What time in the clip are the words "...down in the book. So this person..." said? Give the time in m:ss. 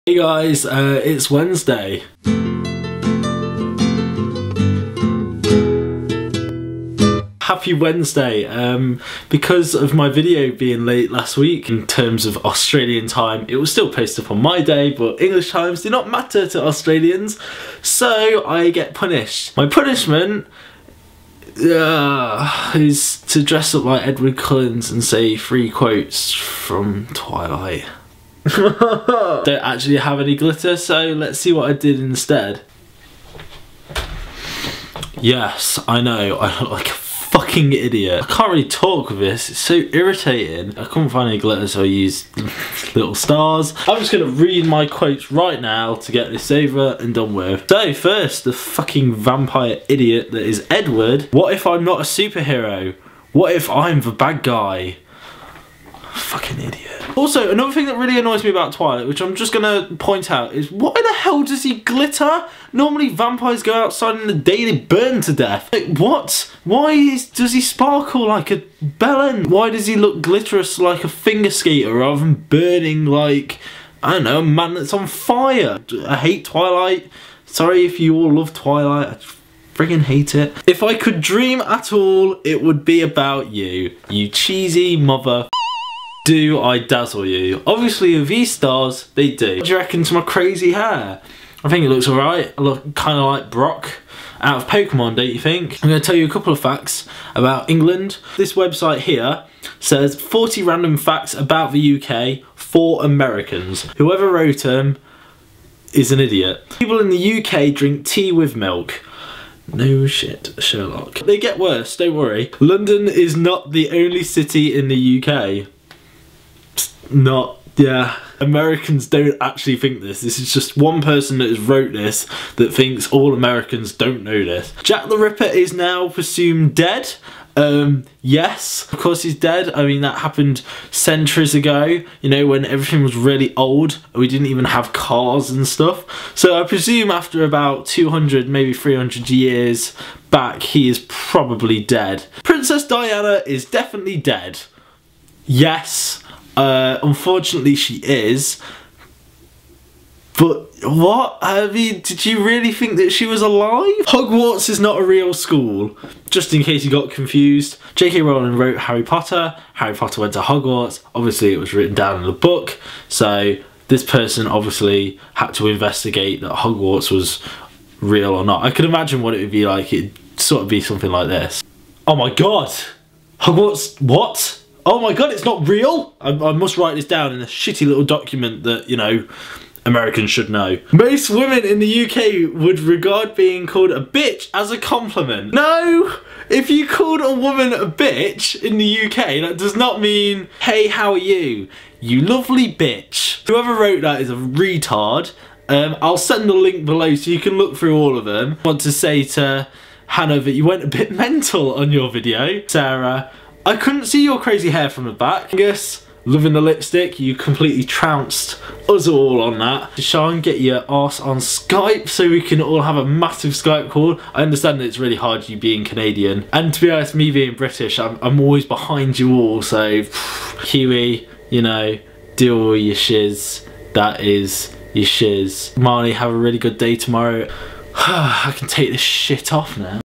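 2:41.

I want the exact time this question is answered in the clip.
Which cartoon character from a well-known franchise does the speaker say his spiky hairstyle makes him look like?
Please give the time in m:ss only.
1:33.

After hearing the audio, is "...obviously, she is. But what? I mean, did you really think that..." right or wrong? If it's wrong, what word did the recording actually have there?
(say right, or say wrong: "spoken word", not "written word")
wrong: "unfortunately", not "obviously".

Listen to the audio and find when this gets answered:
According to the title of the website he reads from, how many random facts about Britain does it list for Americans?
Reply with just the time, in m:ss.
1:40.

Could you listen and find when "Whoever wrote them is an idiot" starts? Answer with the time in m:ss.
1:43.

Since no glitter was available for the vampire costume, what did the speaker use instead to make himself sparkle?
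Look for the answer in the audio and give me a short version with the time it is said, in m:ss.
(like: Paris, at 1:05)
little stars, at 0:42.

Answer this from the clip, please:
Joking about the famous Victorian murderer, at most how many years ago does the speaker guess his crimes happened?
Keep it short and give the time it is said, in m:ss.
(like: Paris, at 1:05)
300, at 2:18.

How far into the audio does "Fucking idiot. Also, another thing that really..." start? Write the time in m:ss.
0:56.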